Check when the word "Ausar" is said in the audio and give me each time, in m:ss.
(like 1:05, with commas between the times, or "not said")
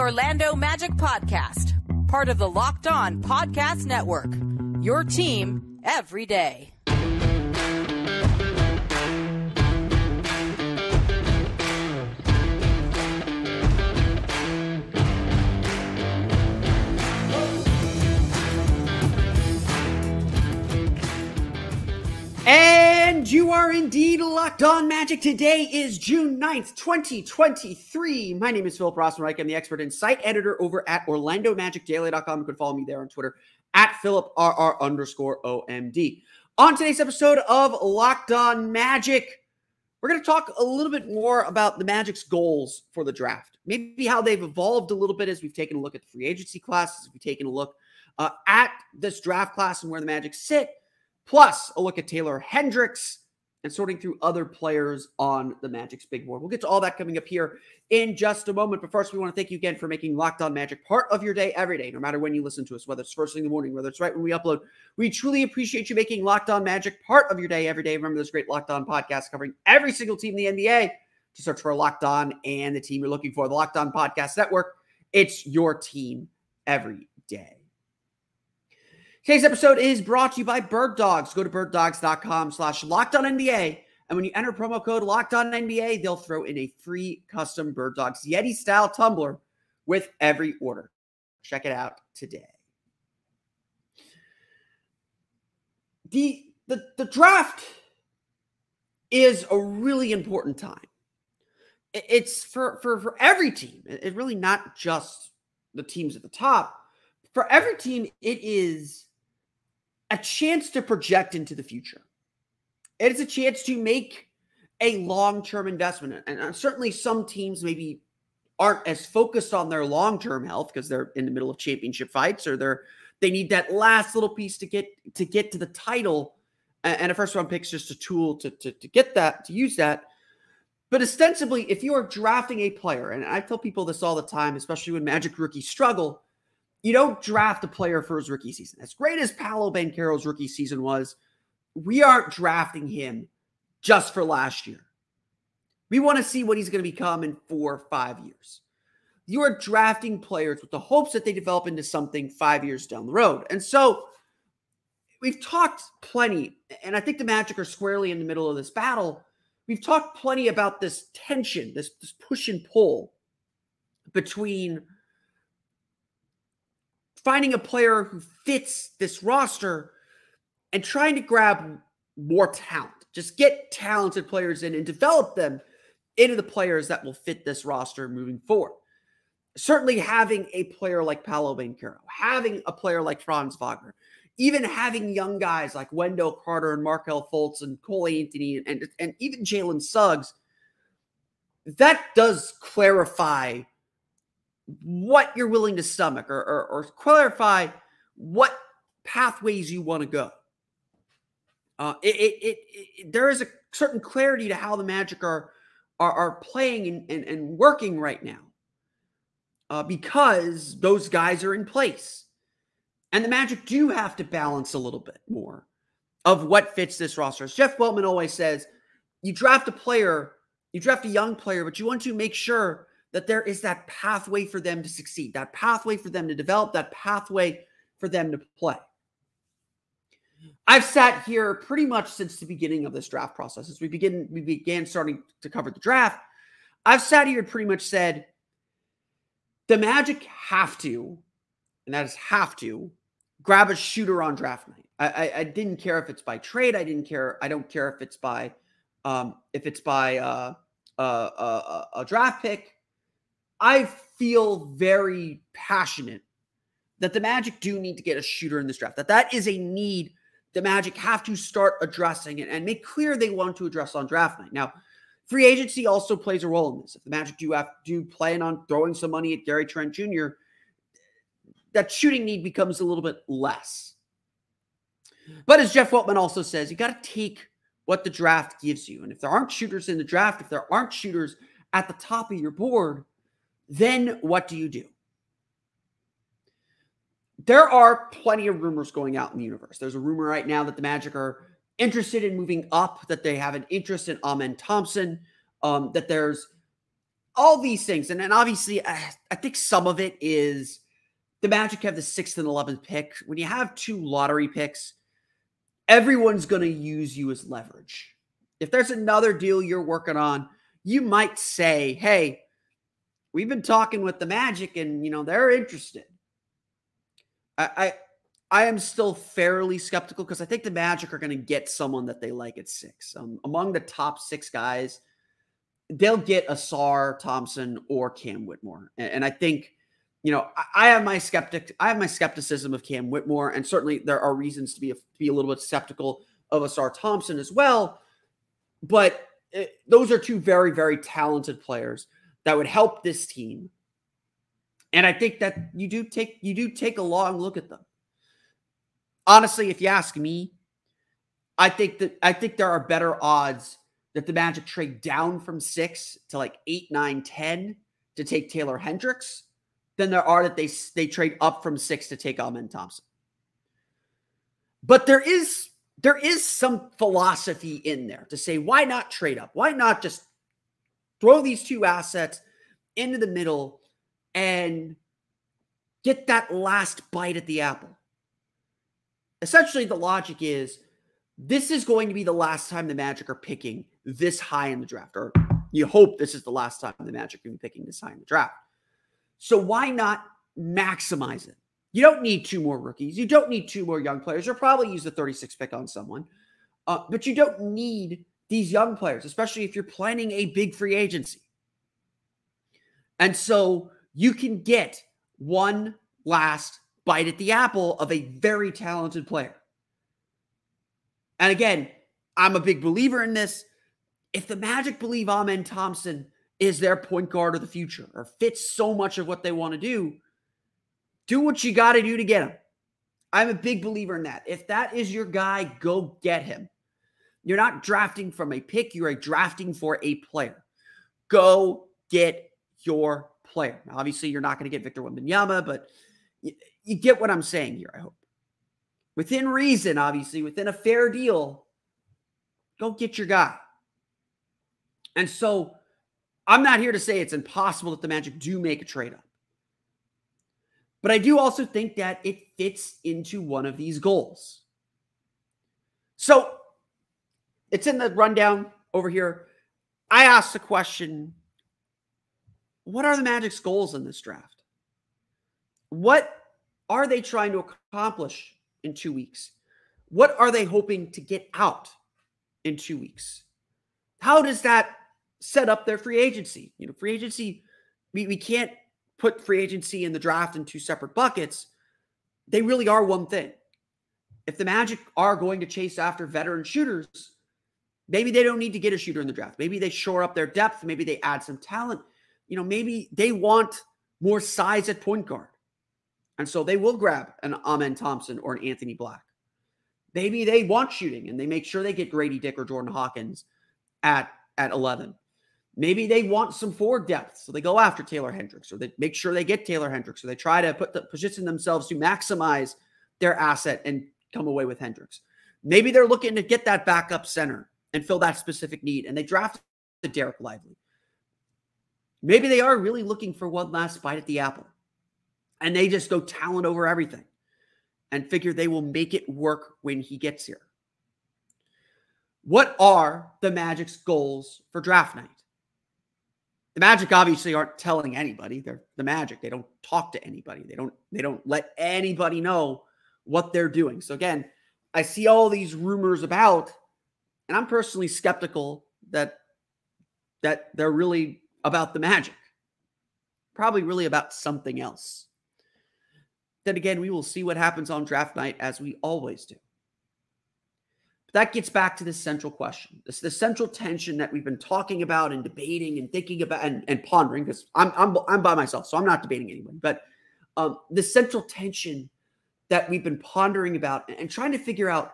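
5:26, 5:36.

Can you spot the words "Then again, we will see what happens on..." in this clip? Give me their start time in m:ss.
9:16.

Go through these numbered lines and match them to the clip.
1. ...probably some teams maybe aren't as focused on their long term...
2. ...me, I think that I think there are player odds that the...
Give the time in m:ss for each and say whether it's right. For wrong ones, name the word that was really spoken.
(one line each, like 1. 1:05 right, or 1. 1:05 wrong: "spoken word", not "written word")
1. 1:56 wrong: "certainly", not "probably"
2. 5:50 wrong: "better", not "player".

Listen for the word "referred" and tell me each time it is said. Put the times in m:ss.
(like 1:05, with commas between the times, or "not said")
not said.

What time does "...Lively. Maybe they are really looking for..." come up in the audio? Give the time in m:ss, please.
8:40.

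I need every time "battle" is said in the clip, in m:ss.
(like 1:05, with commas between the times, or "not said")
2:38.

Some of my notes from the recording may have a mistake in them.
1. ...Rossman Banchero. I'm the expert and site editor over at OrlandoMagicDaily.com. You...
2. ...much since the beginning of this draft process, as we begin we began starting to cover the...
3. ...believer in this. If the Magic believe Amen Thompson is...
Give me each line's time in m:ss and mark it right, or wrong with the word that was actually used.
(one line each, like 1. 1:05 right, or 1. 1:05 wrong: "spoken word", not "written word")
1. 0:28 wrong: "Reich", not "Banchero"
2. 3:51 right
3. 6:52 right.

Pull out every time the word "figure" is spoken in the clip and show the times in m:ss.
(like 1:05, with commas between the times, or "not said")
8:48, 9:34.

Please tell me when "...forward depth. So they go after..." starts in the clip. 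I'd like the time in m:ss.
8:26.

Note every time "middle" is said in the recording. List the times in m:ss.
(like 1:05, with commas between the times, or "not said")
2:01, 2:38, 6:13.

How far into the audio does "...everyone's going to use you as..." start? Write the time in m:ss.
5:05.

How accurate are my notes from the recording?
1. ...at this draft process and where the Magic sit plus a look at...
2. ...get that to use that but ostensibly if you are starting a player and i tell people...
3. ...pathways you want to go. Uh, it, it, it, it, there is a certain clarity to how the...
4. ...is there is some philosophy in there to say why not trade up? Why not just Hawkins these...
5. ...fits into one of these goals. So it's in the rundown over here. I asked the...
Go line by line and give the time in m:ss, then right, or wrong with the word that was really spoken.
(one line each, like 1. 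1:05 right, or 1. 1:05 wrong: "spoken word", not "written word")
1. 0:48 wrong: "class", not "process"
2. 2:08 wrong: "drafting", not "starting"
3. 3:19 right
4. 6:05 wrong: "Throw", not "Hawkins"
5. 7:32 right.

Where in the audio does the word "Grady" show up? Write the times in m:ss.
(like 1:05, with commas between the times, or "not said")
8:22.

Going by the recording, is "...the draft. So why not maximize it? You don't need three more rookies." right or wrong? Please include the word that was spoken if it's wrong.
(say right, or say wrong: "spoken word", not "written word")
wrong: "two", not "three".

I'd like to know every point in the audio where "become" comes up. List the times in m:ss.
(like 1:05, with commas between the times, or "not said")
2:26, 4:32.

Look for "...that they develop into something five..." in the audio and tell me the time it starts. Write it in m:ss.
2:31.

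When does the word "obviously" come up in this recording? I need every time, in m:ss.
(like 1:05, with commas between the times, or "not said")
4:58, 7:13, 7:19, 8:57.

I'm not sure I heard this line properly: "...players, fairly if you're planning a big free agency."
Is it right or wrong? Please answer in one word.
wrong.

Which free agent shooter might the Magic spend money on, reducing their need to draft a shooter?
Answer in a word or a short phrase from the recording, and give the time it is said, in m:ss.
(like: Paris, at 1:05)
Gary Trent Jr., at 4:29.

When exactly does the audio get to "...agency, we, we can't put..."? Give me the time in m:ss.
7:57.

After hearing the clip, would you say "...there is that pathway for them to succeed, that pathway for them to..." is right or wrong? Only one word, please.
right.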